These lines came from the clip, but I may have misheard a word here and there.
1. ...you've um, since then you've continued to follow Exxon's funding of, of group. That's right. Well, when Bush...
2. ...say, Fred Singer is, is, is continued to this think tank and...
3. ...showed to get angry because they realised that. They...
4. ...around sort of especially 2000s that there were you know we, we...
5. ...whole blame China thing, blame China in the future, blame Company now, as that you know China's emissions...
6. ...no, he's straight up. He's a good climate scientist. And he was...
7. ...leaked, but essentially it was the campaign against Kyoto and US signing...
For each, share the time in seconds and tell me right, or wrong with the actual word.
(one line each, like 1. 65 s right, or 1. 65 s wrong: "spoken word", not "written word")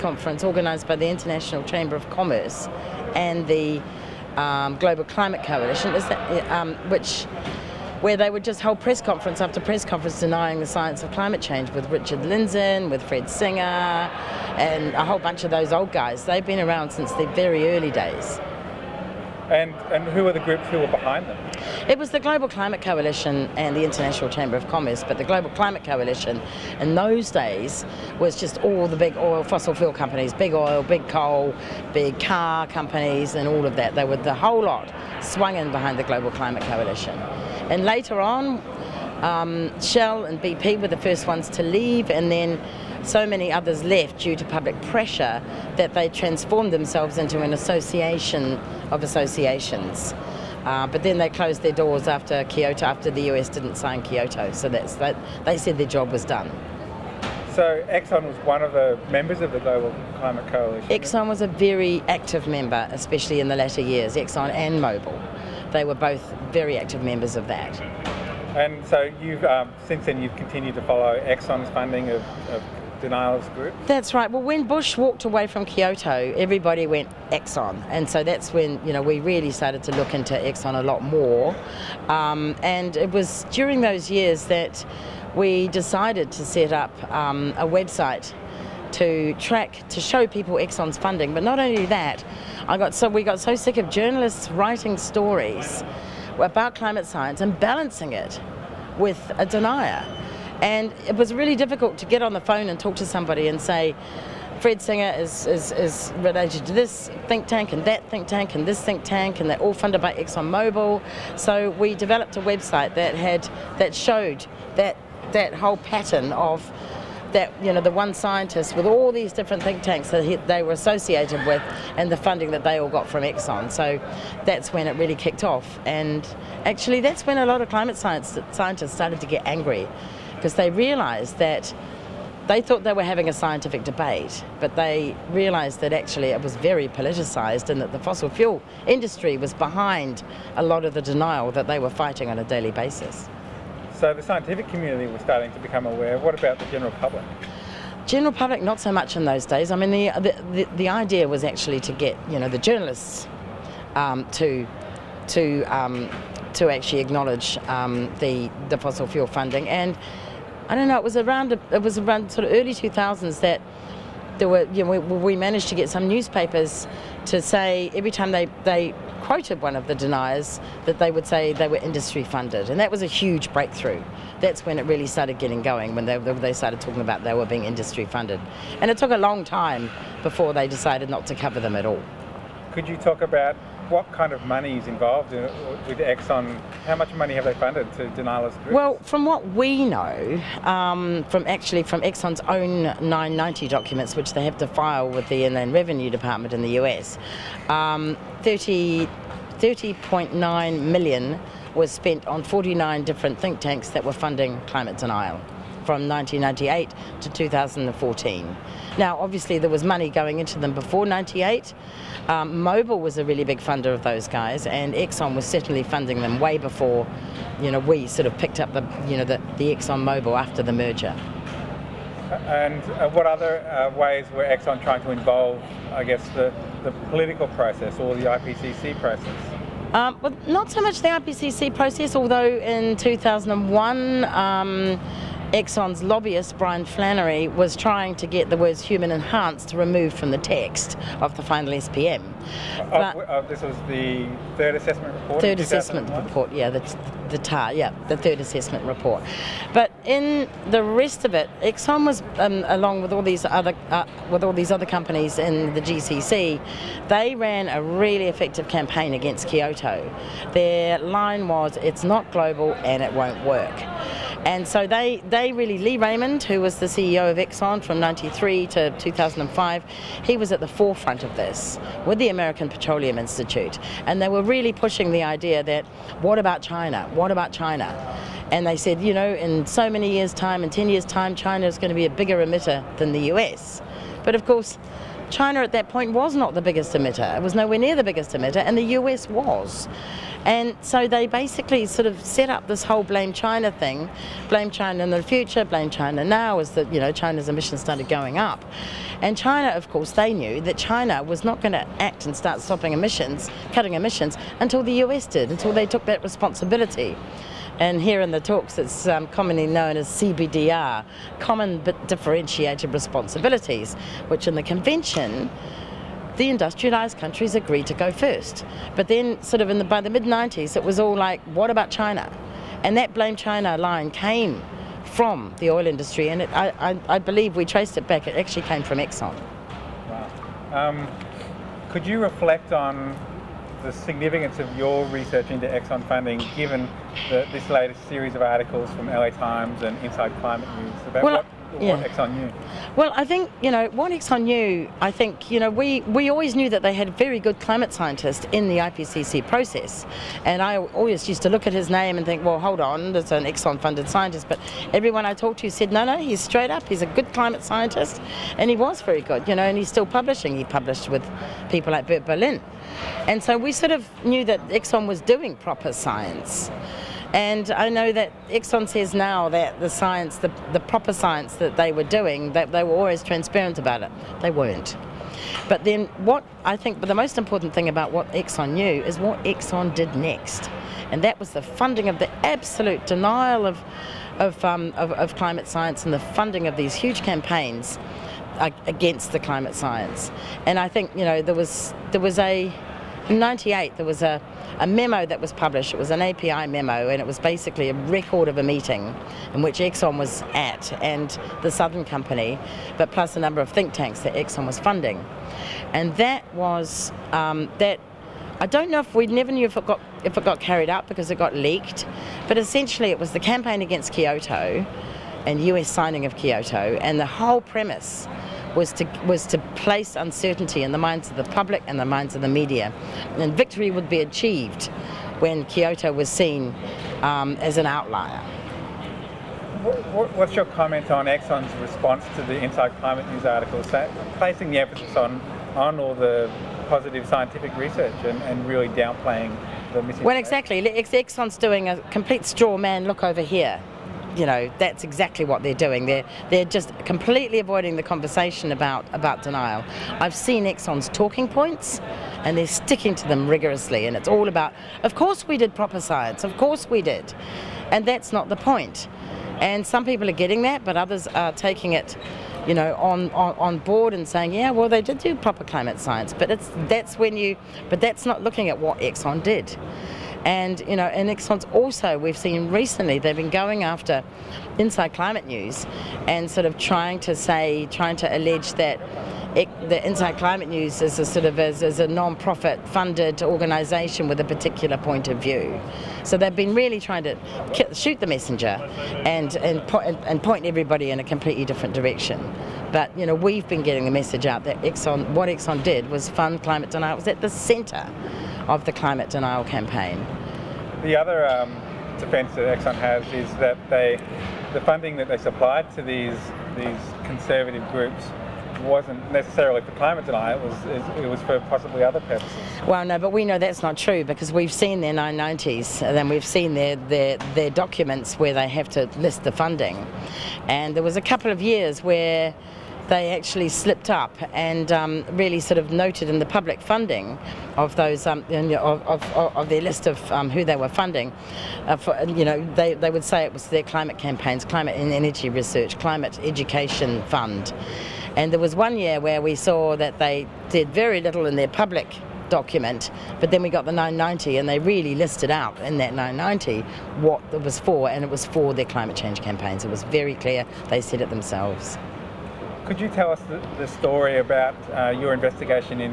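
1. 69 s right
2. 103 s wrong: "related", not "continued"
3. 128 s wrong: "started", not "showed"
4. 161 s wrong: "early", not "especially"
5. 292 s wrong: "China", not "Company"
6. 356 s right
7. 411 s right.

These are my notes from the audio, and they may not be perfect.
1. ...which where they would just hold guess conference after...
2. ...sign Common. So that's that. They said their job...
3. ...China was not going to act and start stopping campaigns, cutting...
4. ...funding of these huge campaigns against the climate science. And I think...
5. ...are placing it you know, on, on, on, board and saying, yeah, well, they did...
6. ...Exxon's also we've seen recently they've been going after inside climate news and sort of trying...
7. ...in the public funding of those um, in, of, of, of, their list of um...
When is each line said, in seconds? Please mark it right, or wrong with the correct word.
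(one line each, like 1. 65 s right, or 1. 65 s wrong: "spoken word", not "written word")
1. 6 s wrong: "press", not "guess"
2. 53 s wrong: "Kyoto", not "Common"
3. 300 s wrong: "emissions", not "campaigns"
4. 386 s right
5. 461 s wrong: "taking", not "placing"
6. 471 s right
7. 526 s right.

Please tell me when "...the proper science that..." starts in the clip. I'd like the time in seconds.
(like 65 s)
370 s.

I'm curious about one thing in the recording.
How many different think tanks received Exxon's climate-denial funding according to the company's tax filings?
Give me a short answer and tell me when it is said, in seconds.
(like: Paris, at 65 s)
49, at 202 s.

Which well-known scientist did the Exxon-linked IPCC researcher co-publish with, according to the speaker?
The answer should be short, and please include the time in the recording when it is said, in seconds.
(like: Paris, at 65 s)
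Bert Bolin, at 362 s.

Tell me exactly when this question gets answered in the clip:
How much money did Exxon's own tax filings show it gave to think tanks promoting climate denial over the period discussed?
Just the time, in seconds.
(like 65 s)
199 s.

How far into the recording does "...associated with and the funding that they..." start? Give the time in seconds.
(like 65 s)
120 s.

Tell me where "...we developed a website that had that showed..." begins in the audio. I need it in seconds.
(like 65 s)
111 s.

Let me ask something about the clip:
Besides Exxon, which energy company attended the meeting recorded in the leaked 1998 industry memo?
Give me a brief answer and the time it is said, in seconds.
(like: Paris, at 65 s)
Southern Company, at 401 s.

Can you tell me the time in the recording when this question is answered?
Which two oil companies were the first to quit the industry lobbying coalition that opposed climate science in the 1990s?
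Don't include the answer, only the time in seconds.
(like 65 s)
39 s.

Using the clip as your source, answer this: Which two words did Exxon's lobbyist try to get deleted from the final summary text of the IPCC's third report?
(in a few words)
human enhanced.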